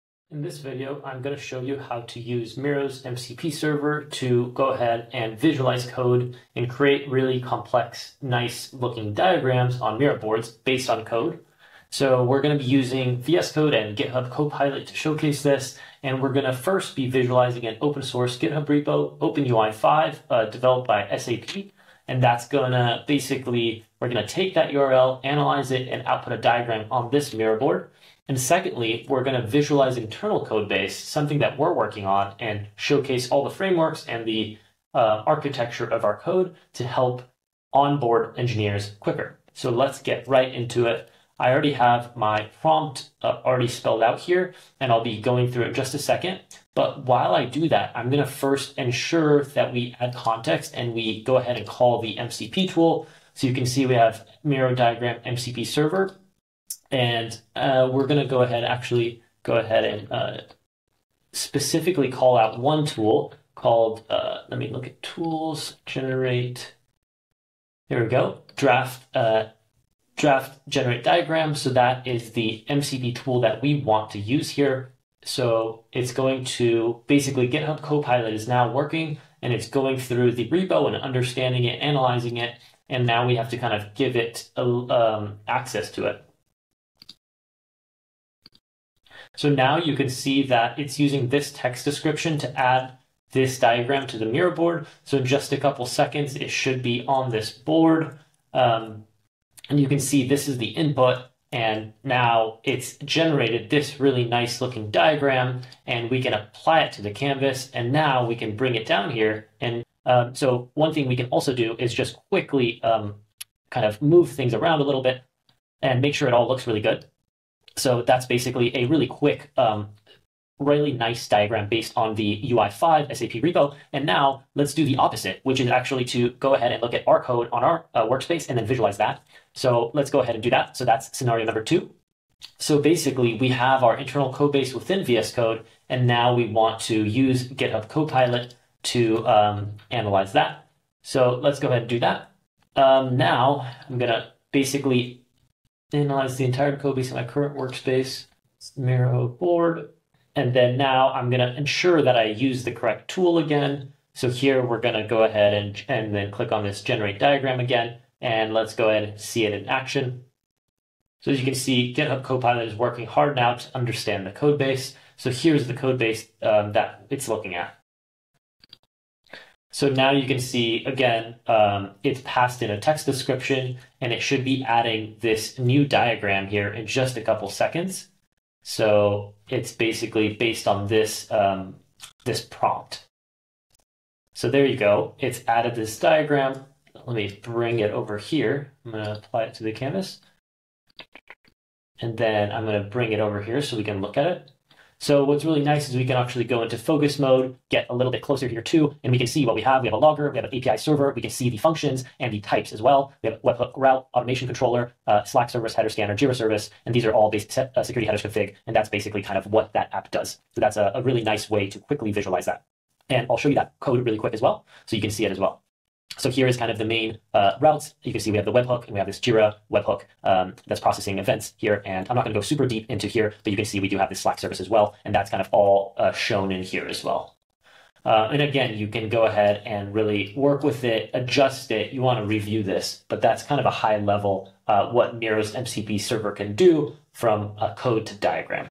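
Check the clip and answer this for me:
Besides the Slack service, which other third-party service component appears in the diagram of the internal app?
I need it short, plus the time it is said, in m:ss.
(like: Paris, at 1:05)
Jira service, at 3:26.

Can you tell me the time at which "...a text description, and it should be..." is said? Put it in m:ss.
2:52.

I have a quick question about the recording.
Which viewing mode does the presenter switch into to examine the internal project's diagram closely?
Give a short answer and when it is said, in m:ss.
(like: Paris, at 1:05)
focus mode, at 3:16.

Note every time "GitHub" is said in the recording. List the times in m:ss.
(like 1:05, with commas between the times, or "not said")
0:13, 0:18, 1:17, 2:17, 2:41.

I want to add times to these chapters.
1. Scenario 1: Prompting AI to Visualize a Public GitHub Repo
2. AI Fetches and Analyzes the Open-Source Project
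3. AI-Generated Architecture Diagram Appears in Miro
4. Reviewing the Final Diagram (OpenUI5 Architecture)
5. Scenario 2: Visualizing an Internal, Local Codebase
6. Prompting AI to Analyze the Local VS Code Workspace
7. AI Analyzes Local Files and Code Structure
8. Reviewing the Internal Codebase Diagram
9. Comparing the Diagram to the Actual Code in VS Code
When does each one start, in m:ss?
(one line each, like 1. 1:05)
1. 0:40
2. 1:20
3. 1:42
4. 2:00
5. 2:12
6. 2:30
7. 2:40
8. 3:15
9. 3:35.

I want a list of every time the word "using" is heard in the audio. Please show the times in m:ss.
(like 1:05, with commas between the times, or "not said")
0:12, 1:30.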